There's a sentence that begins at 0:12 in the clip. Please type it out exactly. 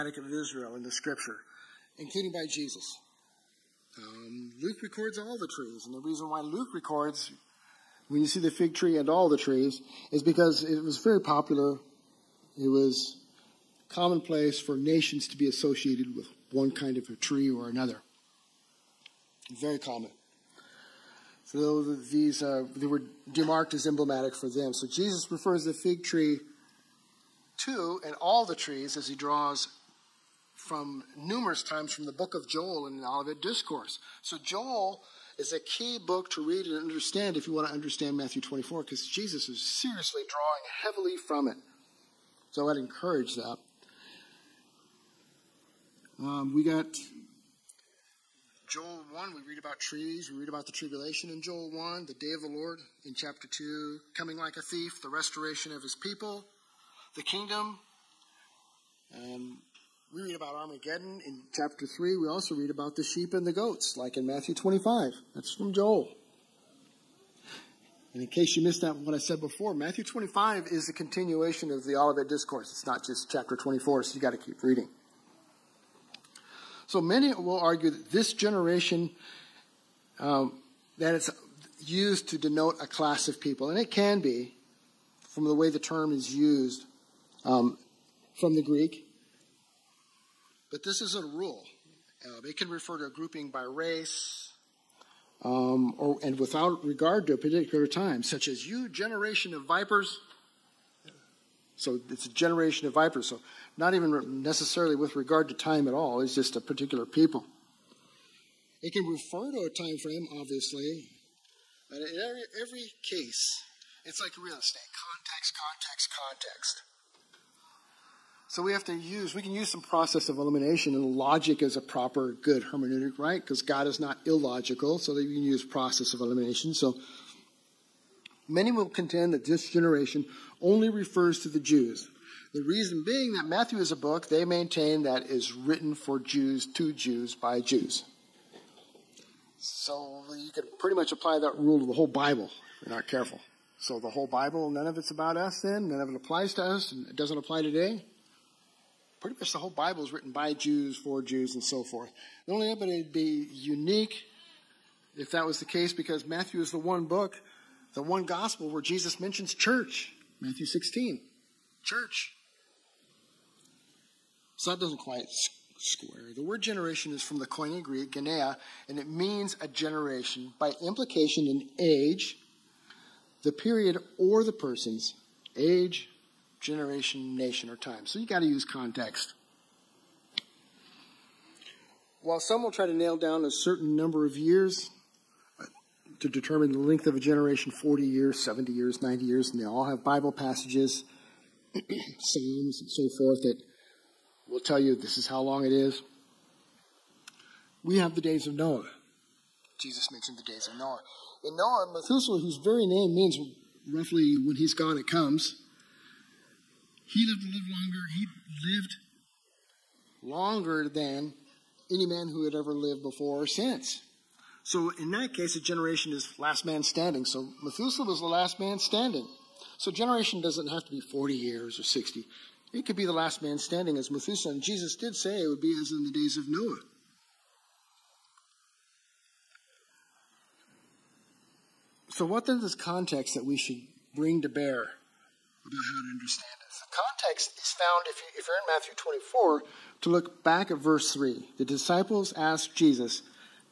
It was commonplace for nations to be associated with one kind of a tree or another.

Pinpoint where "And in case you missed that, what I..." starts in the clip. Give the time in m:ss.
1:08.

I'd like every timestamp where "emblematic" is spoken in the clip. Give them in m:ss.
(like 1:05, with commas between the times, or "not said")
0:23.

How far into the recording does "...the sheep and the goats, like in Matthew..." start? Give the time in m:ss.
1:02.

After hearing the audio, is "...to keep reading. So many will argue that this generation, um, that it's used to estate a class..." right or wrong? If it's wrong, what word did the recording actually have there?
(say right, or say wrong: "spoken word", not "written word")
wrong: "denote", not "estate".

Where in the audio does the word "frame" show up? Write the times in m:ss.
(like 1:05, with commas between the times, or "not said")
1:49.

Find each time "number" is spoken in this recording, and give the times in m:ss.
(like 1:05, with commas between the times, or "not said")
3:03.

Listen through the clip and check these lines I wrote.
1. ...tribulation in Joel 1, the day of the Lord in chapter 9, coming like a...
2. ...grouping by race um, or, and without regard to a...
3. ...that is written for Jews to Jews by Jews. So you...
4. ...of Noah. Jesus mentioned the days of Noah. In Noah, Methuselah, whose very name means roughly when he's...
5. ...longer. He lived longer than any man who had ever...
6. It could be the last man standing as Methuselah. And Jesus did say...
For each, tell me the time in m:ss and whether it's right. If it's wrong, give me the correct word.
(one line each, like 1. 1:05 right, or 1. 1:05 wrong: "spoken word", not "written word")
1. 0:50 wrong: "2", not "9"
2. 1:33 right
3. 2:15 right
4. 3:18 right
5. 3:27 right
6. 3:42 right.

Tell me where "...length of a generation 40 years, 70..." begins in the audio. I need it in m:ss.
3:06.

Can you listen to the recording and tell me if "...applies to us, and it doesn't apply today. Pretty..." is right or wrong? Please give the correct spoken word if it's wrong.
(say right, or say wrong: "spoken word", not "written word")
right.